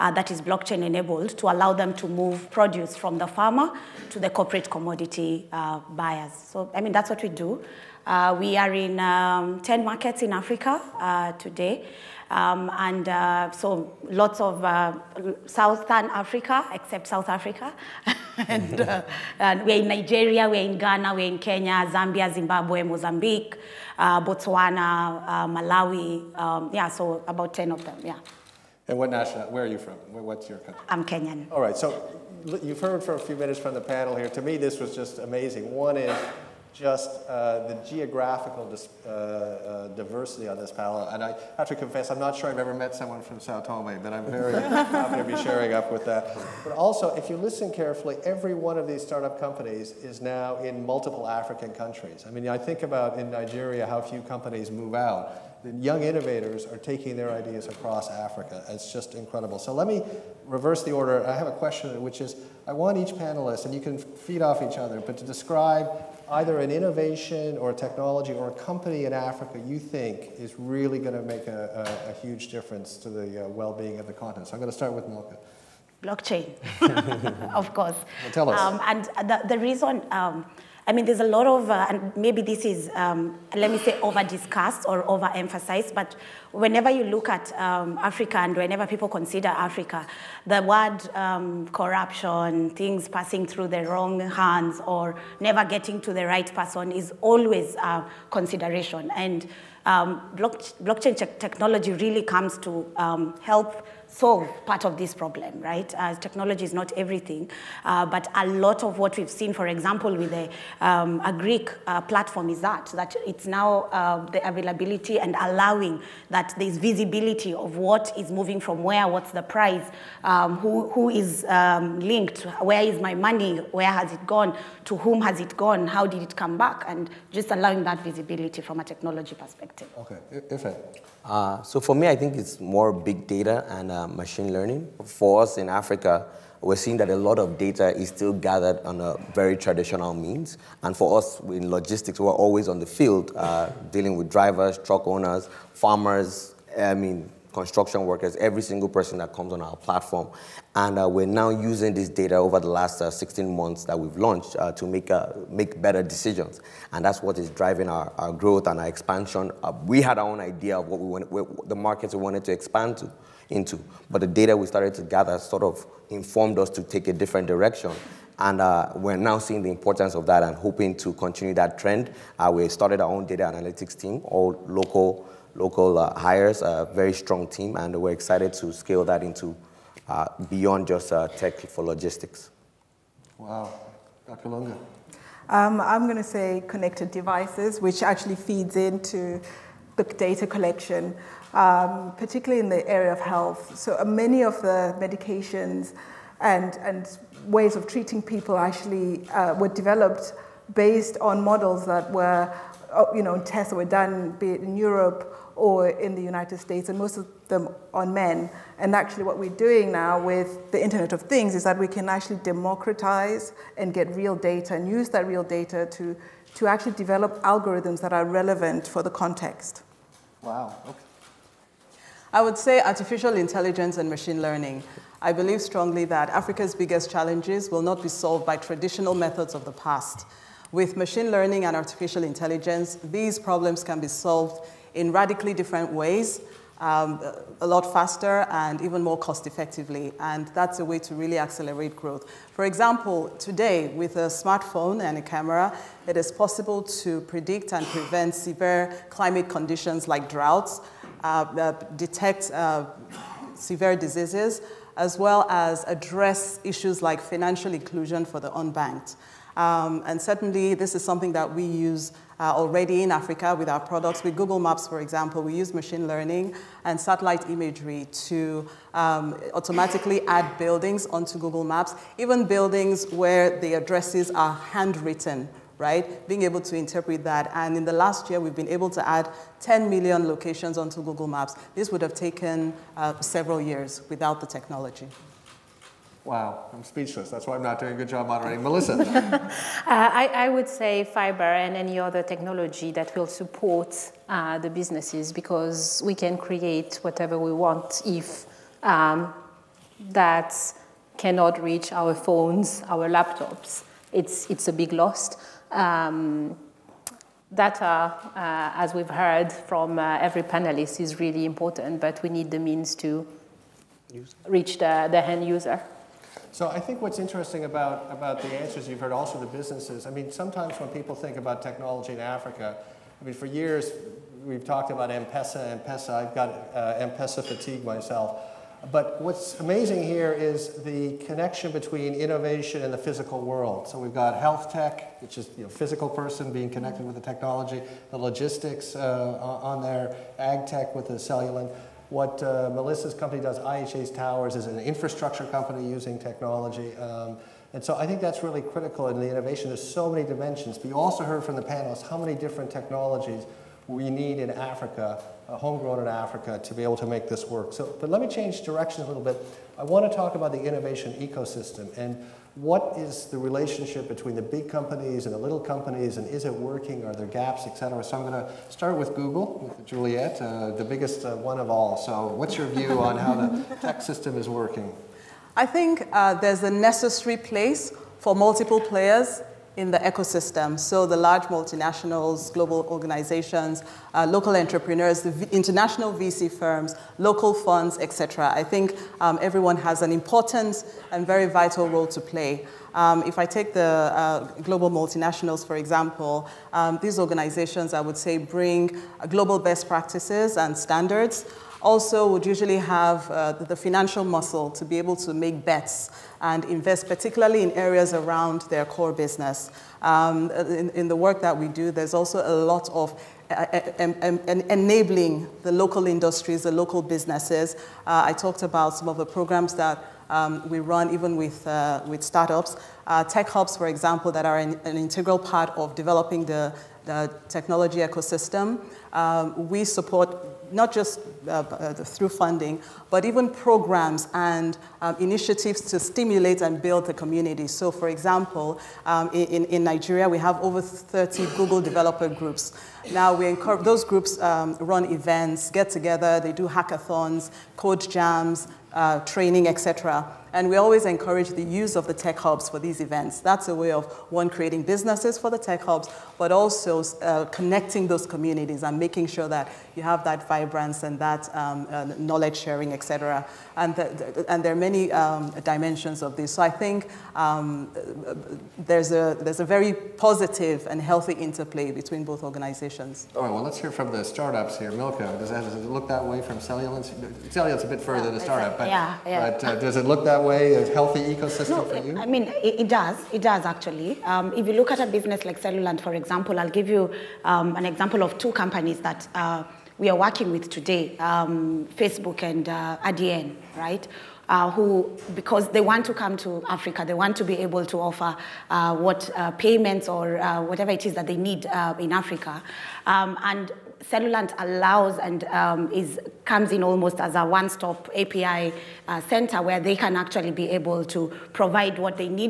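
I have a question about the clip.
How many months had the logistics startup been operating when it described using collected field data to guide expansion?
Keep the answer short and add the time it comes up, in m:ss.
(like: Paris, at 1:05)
16, at 2:33.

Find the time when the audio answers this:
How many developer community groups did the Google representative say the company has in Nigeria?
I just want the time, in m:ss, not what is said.
7:20.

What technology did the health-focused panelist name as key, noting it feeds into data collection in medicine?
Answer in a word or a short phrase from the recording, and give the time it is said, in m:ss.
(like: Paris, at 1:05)
Connected devices, at 3:06.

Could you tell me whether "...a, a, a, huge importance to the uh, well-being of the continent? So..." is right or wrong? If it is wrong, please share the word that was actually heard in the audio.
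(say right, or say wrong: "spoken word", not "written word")
wrong: "difference", not "importance".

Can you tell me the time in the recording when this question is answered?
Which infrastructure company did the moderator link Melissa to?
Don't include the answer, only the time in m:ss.
5:43.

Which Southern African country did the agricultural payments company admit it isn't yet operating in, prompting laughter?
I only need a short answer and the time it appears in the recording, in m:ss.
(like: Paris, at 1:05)
South Africa, at 0:17.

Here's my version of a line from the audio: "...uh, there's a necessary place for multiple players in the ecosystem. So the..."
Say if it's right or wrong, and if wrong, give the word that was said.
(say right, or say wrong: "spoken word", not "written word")
right.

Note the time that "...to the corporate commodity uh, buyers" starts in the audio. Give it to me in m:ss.
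0:04.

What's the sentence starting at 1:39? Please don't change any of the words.
And um, blockchain technology really comes to um, help solve part of this problem, right?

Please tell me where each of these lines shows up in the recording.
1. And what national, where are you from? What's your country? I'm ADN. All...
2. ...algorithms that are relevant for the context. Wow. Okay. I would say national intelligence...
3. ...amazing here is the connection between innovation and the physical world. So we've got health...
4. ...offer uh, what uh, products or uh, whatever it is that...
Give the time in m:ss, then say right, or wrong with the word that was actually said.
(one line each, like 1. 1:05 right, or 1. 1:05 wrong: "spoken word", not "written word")
1. 0:28 wrong: "Kenyan", not "ADN"
2. 3:37 wrong: "artificial", not "national"
3. 5:29 right
4. 8:17 wrong: "payments", not "products".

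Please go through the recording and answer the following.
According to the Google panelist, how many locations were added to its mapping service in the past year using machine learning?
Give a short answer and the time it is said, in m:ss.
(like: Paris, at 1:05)
10 million, at 4:39.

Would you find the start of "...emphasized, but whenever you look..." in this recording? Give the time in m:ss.
1:25.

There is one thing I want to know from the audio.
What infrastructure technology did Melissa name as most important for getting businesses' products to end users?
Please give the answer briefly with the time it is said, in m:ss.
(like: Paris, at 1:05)
Fiber, at 4:51.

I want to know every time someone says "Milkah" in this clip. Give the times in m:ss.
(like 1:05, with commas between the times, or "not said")
1:15, 7:54.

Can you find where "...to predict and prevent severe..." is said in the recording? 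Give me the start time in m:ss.
4:07.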